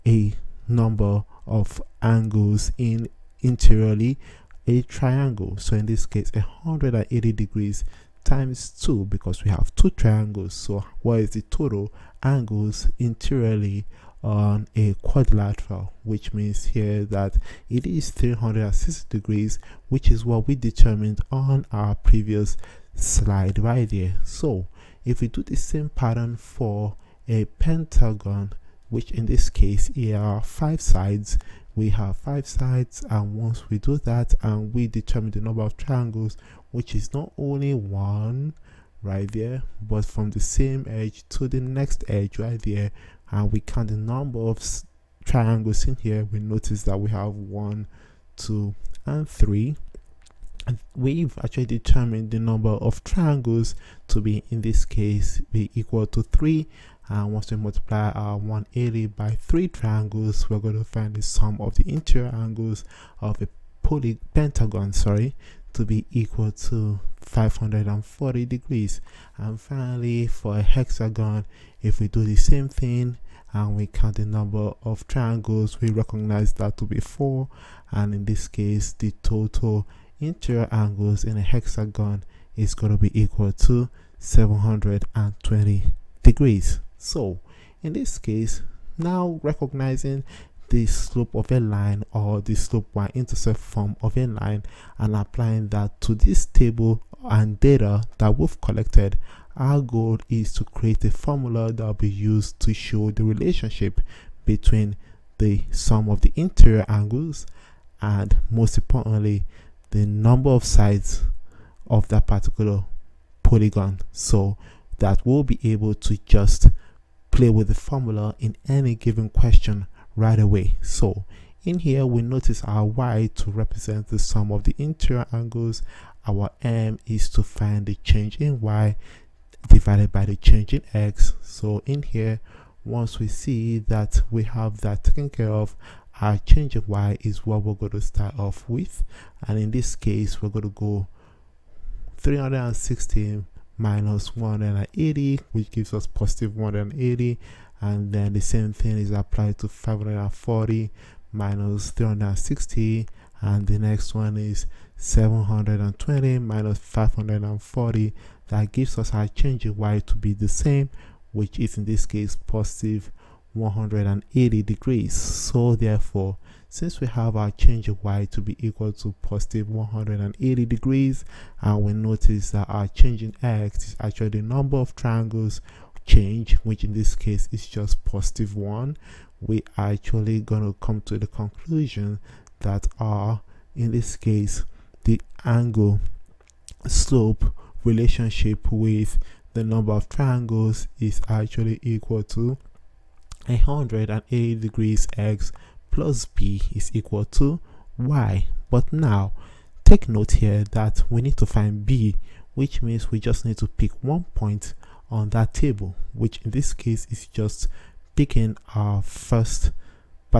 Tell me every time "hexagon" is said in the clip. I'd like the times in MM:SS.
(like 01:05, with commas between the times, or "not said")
01:10, 01:21.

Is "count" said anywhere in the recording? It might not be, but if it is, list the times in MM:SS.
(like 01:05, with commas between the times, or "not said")
00:43, 01:13.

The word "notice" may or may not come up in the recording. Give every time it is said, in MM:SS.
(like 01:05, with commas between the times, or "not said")
00:46, 02:02, 02:51.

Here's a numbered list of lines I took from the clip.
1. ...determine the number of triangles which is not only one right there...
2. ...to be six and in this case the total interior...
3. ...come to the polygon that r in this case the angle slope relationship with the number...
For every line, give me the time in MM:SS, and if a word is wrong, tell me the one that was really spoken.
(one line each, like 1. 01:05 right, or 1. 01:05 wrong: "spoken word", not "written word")
1. 00:34 right
2. 01:16 wrong: "four", not "six"
3. 03:00 wrong: "conclusion", not "polygon".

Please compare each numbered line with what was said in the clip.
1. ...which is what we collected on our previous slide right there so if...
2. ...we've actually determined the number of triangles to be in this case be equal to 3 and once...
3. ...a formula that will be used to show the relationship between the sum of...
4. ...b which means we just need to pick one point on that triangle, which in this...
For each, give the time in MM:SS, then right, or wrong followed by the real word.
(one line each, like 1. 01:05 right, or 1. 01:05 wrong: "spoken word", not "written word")
1. 00:19 wrong: "determined", not "collected"
2. 00:50 right
3. 01:41 right
4. 03:21 wrong: "table", not "triangle".